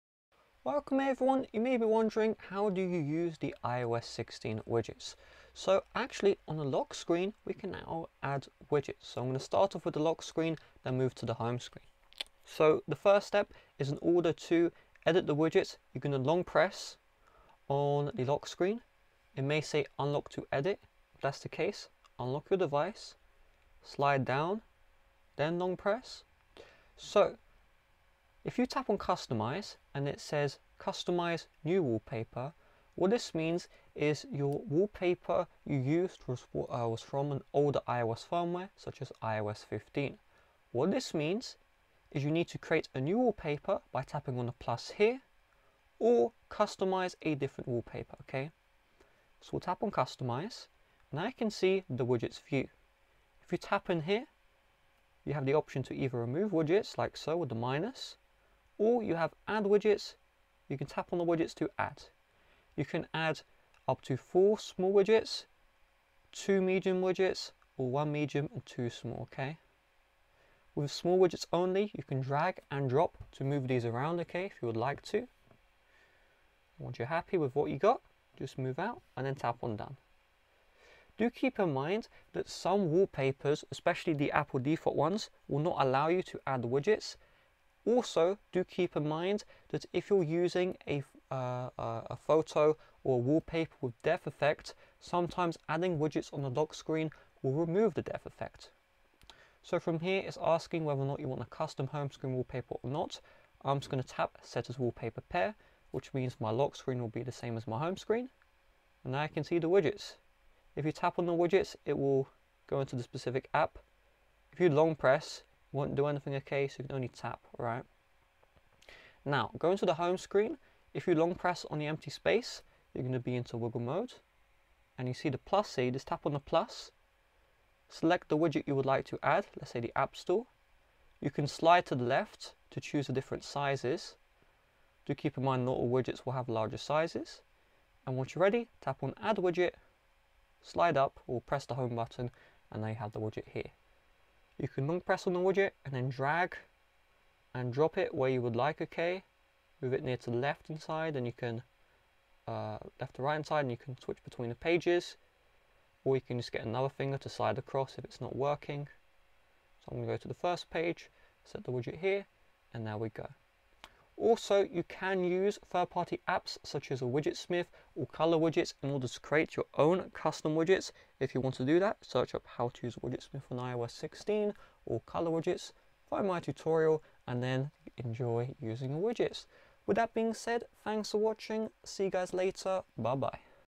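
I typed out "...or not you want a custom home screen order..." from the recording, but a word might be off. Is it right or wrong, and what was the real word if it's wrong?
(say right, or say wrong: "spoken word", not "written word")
wrong: "wallpaper", not "order".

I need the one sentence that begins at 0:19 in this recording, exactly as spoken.
It may say unlock to edit.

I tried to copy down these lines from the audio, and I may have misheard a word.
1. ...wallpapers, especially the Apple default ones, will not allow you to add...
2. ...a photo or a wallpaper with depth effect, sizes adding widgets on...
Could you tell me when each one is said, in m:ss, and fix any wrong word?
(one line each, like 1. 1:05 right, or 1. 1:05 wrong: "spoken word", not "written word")
1. 1:22 right
2. 1:32 wrong: "sometimes", not "sizes".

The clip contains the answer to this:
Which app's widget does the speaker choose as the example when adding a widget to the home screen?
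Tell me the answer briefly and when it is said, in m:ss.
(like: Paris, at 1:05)
App Store, at 2:09.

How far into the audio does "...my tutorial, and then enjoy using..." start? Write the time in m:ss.
2:56.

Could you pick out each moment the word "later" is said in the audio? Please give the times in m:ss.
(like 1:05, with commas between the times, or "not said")
3:02.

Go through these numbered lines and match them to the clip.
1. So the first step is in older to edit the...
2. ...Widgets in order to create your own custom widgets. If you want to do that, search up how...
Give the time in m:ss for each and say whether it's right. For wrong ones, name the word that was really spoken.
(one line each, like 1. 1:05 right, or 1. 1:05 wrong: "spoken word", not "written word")
1. 0:12 wrong: "order", not "older"
2. 2:48 right.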